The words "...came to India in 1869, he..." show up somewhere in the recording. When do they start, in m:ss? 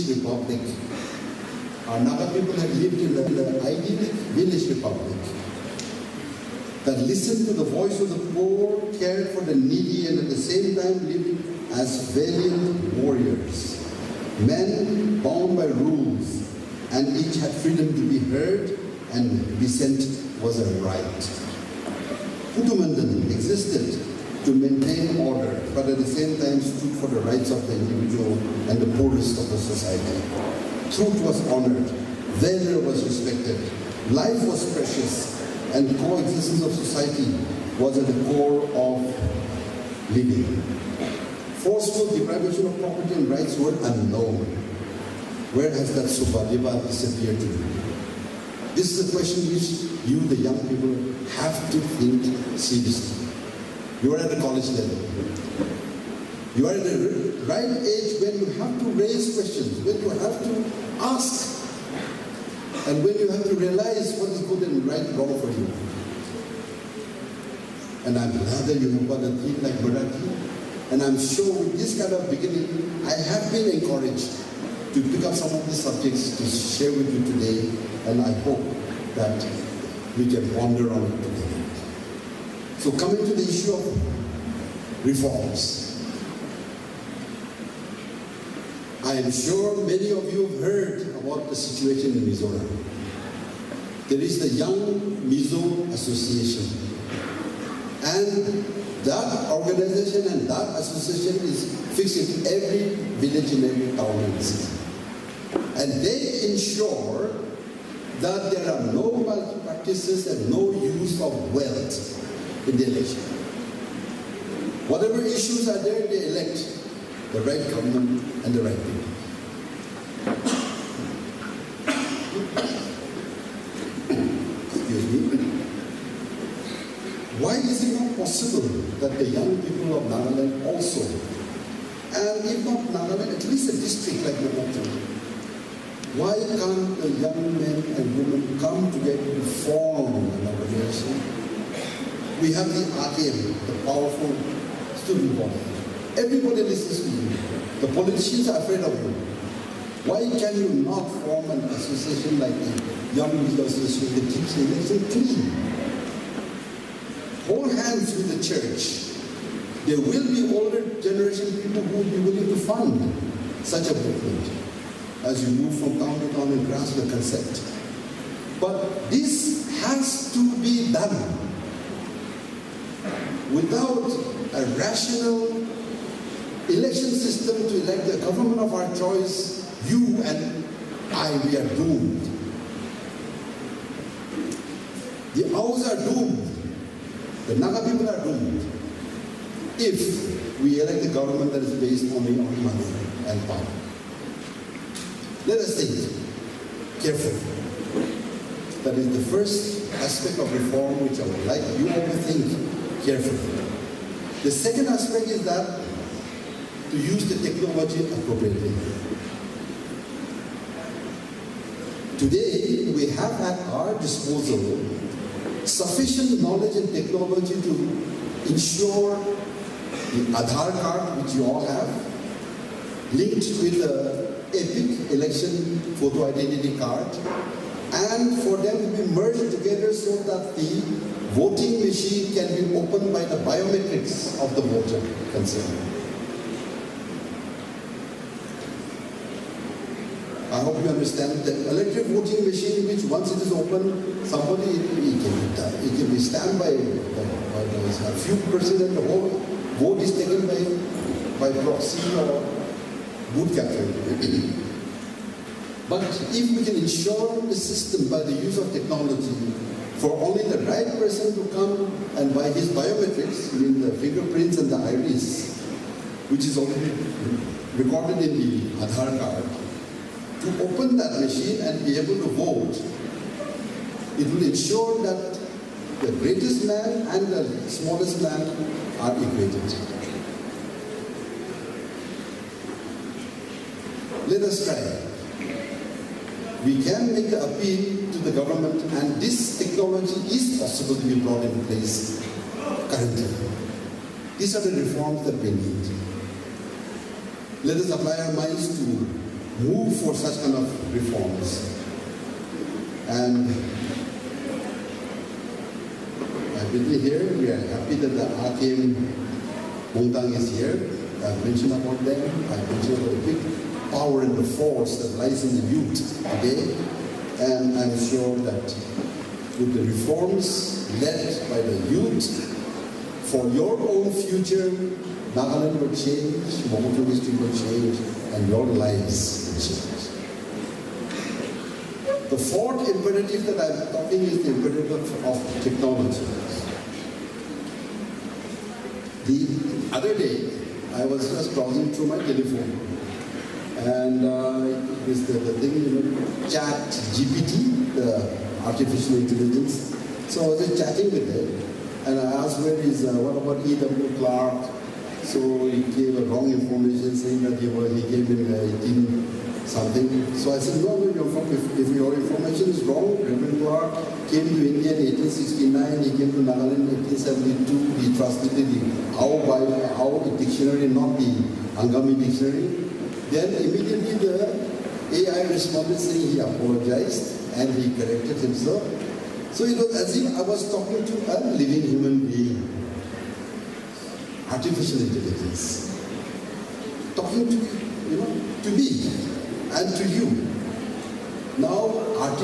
6:04.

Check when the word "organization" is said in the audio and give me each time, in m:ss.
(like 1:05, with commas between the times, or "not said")
1:39, 2:20.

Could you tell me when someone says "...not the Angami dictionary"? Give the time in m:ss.
6:10.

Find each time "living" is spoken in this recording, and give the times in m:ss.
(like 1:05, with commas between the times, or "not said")
0:40, 6:21.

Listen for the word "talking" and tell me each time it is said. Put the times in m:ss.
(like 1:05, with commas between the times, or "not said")
5:33, 6:20, 6:27.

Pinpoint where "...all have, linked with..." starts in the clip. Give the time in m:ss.
3:41.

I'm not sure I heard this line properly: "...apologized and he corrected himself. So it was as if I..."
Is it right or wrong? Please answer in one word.
right.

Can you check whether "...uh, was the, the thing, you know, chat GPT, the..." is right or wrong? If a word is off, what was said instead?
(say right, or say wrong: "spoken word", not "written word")
right.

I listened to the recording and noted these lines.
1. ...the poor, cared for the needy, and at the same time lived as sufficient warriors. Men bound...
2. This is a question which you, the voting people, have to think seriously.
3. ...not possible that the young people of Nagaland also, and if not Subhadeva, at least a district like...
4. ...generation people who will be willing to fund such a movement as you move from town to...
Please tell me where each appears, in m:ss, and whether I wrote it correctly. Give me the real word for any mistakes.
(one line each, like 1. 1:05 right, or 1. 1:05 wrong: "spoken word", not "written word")
1. 0:08 wrong: "valiant", not "sufficient"
2. 0:48 wrong: "young", not "voting"
3. 2:08 wrong: "Nagaland", not "Subhadeva"
4. 2:41 right.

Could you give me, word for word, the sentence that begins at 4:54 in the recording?
These are the reforms that we need.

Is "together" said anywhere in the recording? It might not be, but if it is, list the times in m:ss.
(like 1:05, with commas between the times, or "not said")
1:21, 2:18, 3:49.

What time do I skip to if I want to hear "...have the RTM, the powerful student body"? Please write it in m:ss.
2:22.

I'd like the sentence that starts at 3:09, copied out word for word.
If we elect a government that is based only on money and power.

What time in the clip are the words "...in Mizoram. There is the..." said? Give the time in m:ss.
1:32.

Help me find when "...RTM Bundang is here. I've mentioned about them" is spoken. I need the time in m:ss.
5:08.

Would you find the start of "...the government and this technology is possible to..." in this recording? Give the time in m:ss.
4:48.